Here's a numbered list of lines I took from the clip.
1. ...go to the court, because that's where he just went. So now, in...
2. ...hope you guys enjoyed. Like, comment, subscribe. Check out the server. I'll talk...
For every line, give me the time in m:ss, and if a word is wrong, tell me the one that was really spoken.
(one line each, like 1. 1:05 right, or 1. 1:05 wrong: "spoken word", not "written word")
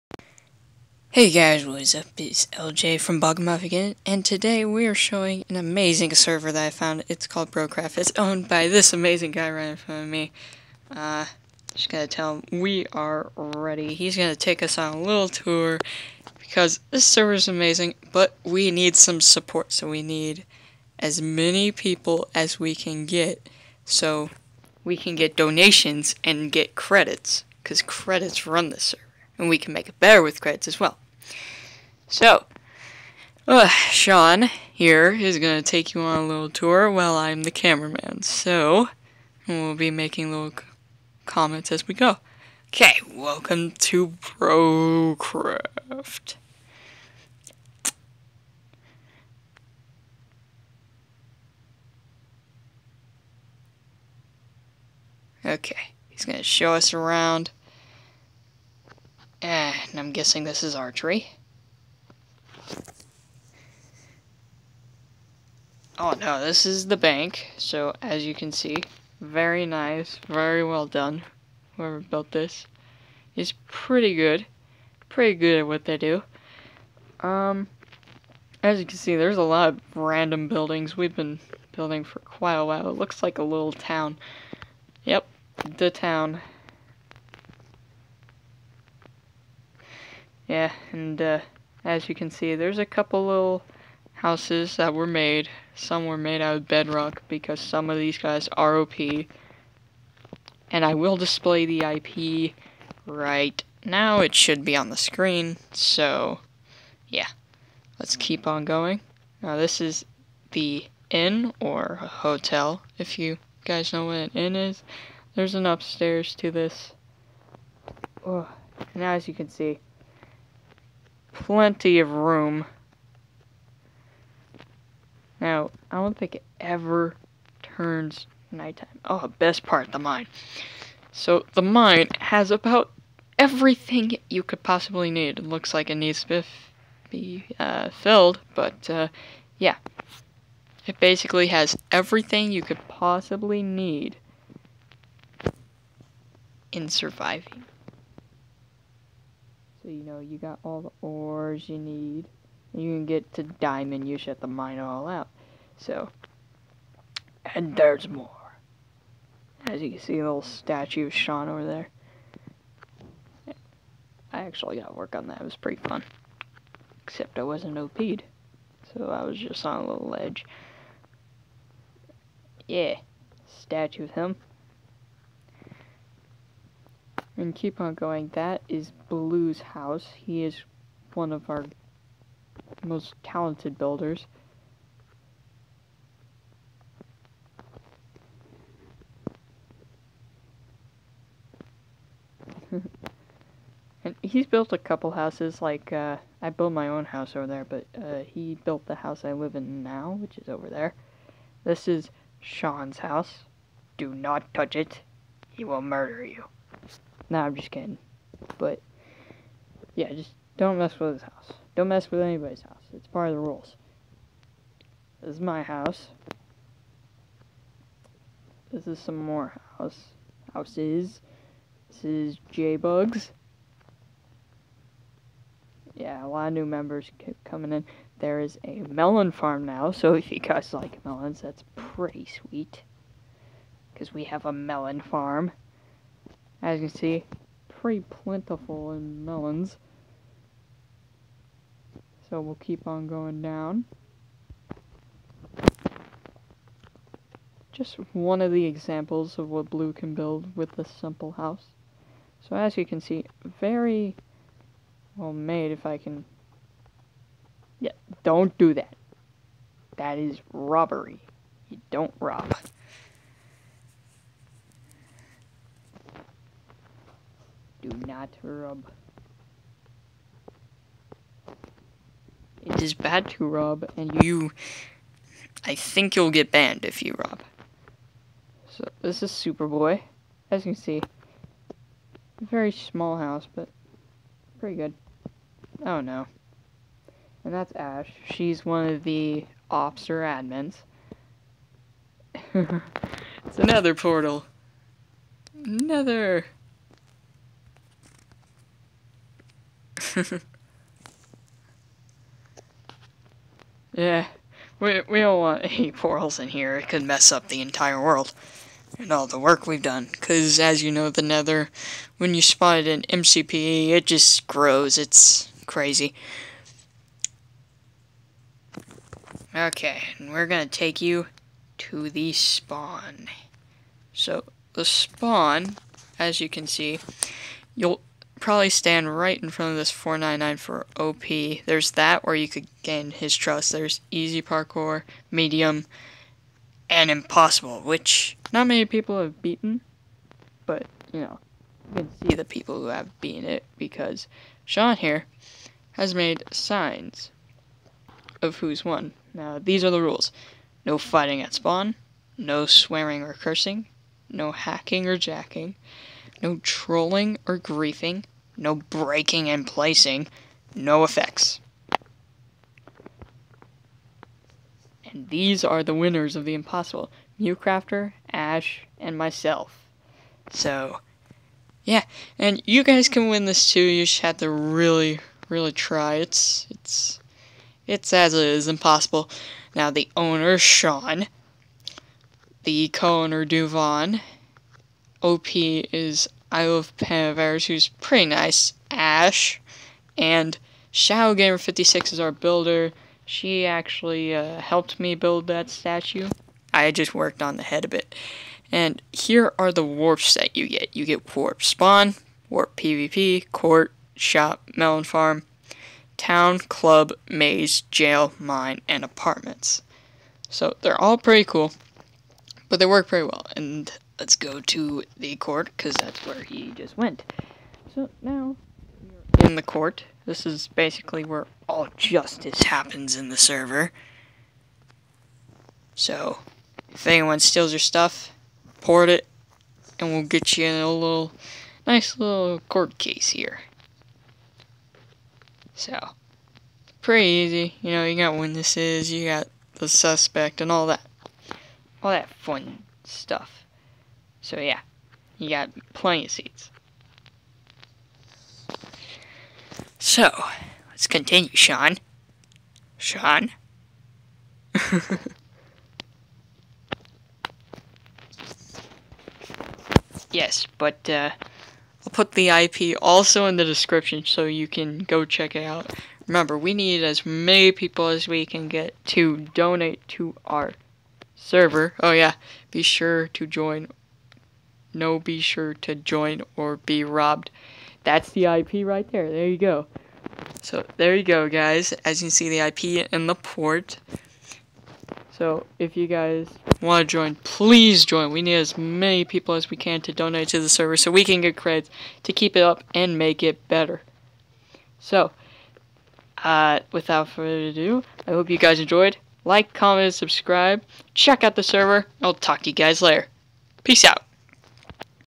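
1. 6:54 right
2. 8:18 right.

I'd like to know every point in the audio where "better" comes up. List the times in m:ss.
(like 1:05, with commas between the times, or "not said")
0:29, 8:13.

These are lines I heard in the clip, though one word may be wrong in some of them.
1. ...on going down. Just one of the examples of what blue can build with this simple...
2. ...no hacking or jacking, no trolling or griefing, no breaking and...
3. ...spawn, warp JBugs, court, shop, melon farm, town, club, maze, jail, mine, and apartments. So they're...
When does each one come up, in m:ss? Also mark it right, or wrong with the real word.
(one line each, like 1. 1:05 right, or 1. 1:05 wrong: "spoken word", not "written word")
1. 4:02 right
2. 5:54 right
3. 6:41 wrong: "PvP", not "JBugs".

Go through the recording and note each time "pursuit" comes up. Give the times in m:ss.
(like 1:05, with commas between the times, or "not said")
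not said.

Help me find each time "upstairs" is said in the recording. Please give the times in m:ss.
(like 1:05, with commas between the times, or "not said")
1:55.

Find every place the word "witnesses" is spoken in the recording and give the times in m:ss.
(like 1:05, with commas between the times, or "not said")
7:18.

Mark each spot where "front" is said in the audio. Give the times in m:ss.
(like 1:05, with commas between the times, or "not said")
0:09, 5:29.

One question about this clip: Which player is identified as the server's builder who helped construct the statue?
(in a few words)
ShadowGamer56.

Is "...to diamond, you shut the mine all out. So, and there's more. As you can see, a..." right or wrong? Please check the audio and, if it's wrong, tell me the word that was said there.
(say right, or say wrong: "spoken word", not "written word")
right.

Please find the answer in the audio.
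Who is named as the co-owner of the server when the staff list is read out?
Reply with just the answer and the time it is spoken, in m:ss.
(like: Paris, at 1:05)
Duvon, at 6:23.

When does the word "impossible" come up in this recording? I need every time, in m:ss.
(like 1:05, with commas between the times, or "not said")
5:37, 6:06, 6:18.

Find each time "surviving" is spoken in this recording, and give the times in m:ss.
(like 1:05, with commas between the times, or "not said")
2:26.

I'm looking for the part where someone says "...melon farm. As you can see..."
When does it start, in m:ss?
3:54.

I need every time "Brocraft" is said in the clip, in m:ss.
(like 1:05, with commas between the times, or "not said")
0:07, 0:44.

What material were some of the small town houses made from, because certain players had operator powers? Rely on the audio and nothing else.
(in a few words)
bedrock.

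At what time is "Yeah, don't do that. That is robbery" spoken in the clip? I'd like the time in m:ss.
4:17.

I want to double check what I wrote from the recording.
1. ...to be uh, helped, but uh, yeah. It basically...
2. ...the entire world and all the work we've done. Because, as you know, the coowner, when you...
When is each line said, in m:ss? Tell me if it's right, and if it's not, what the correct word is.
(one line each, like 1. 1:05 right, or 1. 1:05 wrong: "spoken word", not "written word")
1. 2:16 wrong: "filled", not "helped"
2. 5:07 wrong: "nether", not "coowner".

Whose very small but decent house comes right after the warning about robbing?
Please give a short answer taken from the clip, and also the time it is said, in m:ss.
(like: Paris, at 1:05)
Superboy, at 4:39.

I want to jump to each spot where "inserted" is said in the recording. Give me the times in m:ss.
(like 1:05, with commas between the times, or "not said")
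not said.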